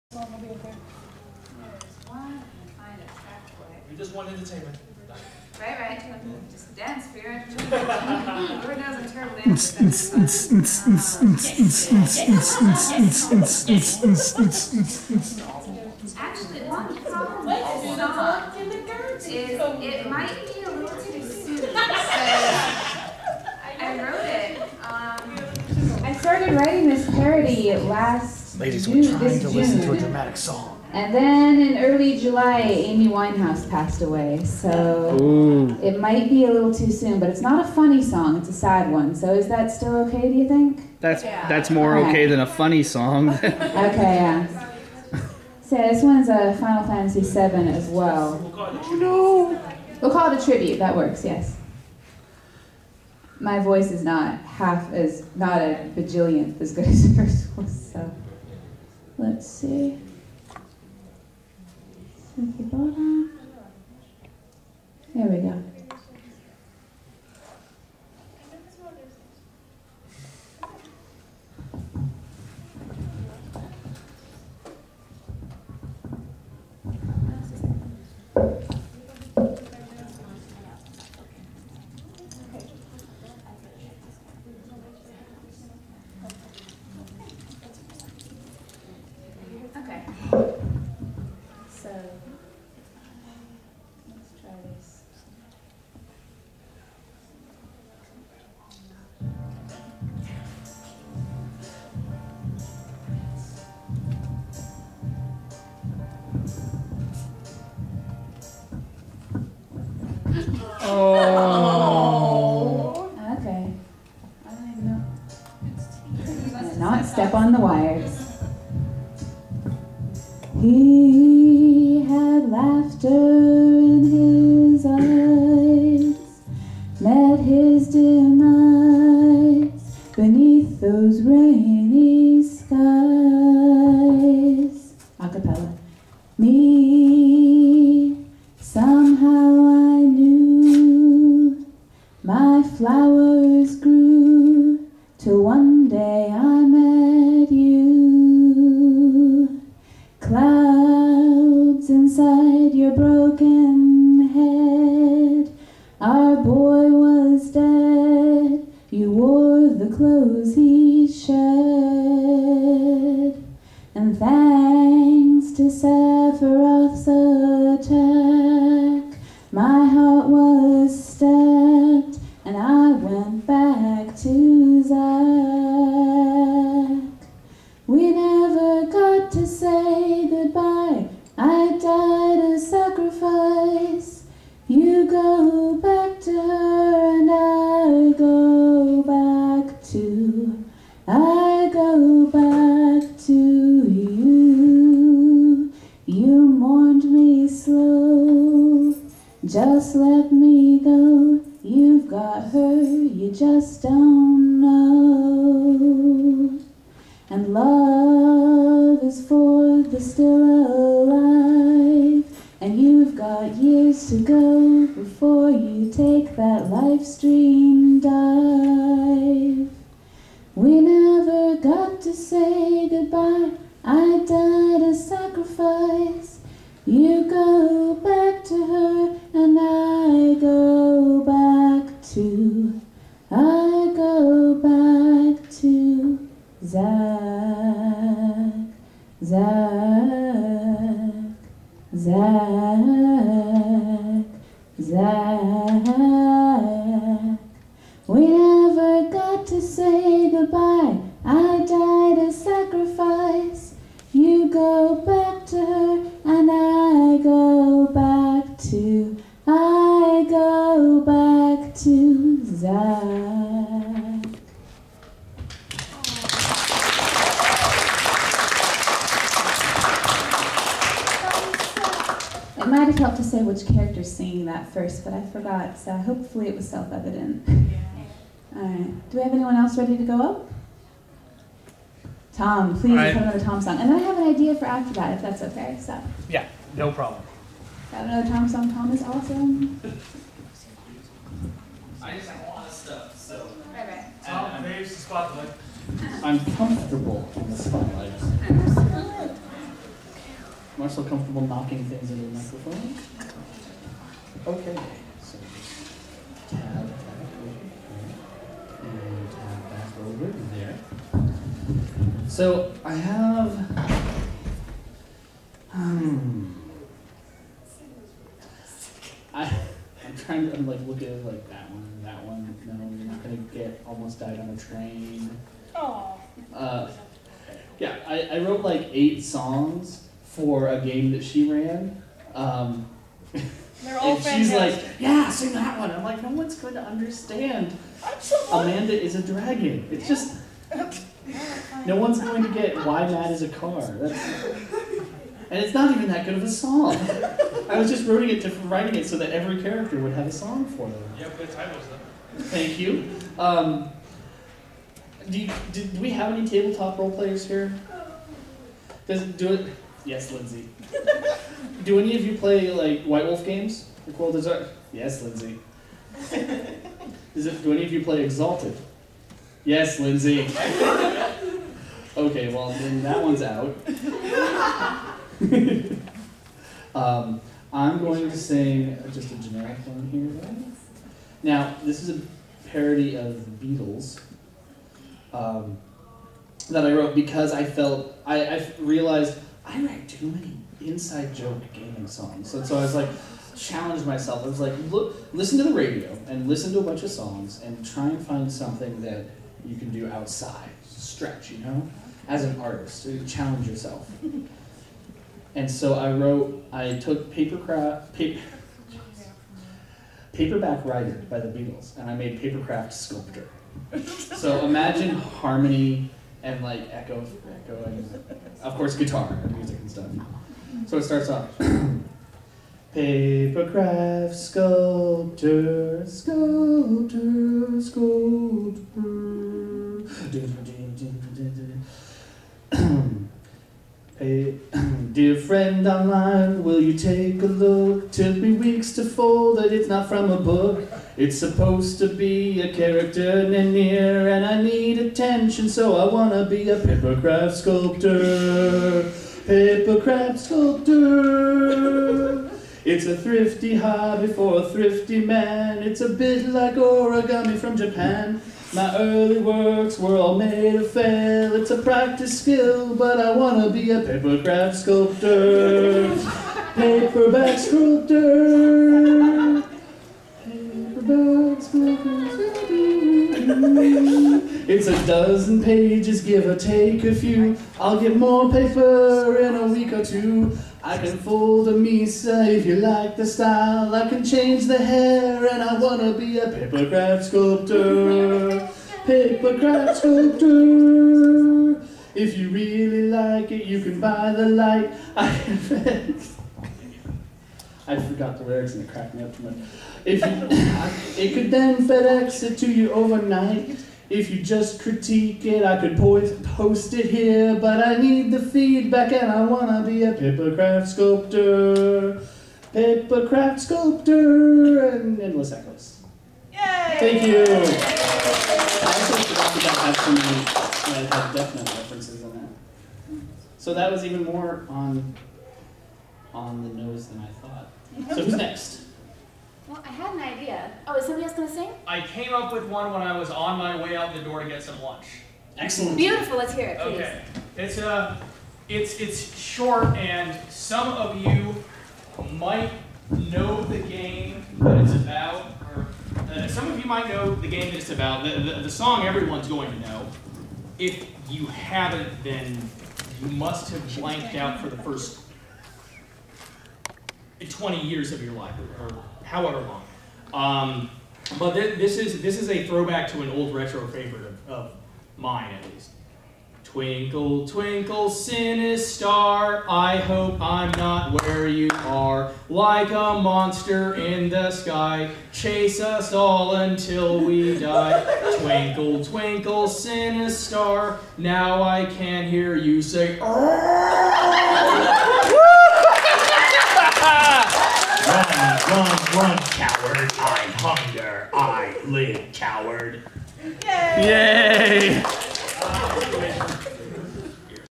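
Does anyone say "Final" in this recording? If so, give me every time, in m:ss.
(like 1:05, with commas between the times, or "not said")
0:46.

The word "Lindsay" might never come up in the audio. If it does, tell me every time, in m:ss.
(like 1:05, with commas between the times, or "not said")
6:00, 6:05, 6:09.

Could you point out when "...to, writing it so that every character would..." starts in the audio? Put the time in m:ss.
5:48.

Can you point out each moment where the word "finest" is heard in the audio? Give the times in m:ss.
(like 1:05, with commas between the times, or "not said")
not said.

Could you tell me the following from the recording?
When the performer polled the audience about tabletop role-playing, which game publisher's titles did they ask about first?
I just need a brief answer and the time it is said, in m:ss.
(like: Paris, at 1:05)
White Wolf, at 6:03.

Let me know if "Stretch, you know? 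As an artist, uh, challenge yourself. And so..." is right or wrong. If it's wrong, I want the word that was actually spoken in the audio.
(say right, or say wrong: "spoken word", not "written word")
right.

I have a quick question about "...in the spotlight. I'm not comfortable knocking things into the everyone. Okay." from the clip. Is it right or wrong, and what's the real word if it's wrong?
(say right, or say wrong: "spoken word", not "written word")
wrong: "microphone", not "everyone".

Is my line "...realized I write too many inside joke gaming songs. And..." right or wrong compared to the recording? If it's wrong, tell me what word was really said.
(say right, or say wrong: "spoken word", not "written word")
right.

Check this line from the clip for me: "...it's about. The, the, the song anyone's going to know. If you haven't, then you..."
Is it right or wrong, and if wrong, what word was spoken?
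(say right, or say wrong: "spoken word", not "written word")
wrong: "everyone", not "anyone".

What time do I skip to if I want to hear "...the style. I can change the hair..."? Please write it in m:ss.
8:03.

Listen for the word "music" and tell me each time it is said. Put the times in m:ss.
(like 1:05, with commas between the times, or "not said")
6:59.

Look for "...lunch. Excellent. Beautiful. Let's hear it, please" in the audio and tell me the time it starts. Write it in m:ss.
8:54.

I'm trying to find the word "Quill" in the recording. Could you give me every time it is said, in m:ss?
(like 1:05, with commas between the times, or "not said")
6:04.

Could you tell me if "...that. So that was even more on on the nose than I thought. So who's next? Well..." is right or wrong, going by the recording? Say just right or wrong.
right.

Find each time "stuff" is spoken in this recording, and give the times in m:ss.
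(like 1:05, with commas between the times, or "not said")
4:52, 6:59.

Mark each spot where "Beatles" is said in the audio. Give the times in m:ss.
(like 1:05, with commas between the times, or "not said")
6:23, 6:51.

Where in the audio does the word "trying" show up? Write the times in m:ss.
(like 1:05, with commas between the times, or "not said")
0:29, 5:20.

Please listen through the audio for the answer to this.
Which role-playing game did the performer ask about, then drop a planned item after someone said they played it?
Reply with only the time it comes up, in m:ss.
6:08.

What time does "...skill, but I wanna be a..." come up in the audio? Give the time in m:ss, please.
7:42.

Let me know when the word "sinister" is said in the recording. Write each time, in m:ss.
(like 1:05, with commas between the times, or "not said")
9:28, 9:39.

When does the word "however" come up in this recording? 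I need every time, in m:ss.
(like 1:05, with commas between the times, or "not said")
9:19.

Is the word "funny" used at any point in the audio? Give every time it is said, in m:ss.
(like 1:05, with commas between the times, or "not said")
0:37, 0:42.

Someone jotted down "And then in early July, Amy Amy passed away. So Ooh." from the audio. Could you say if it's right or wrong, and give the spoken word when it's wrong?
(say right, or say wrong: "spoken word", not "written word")
wrong: "Winehouse", not "Amy".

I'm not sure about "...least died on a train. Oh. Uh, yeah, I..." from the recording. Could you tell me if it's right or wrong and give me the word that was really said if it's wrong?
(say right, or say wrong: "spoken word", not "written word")
wrong: "almost", not "least".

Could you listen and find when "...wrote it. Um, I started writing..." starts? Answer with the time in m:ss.
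0:24.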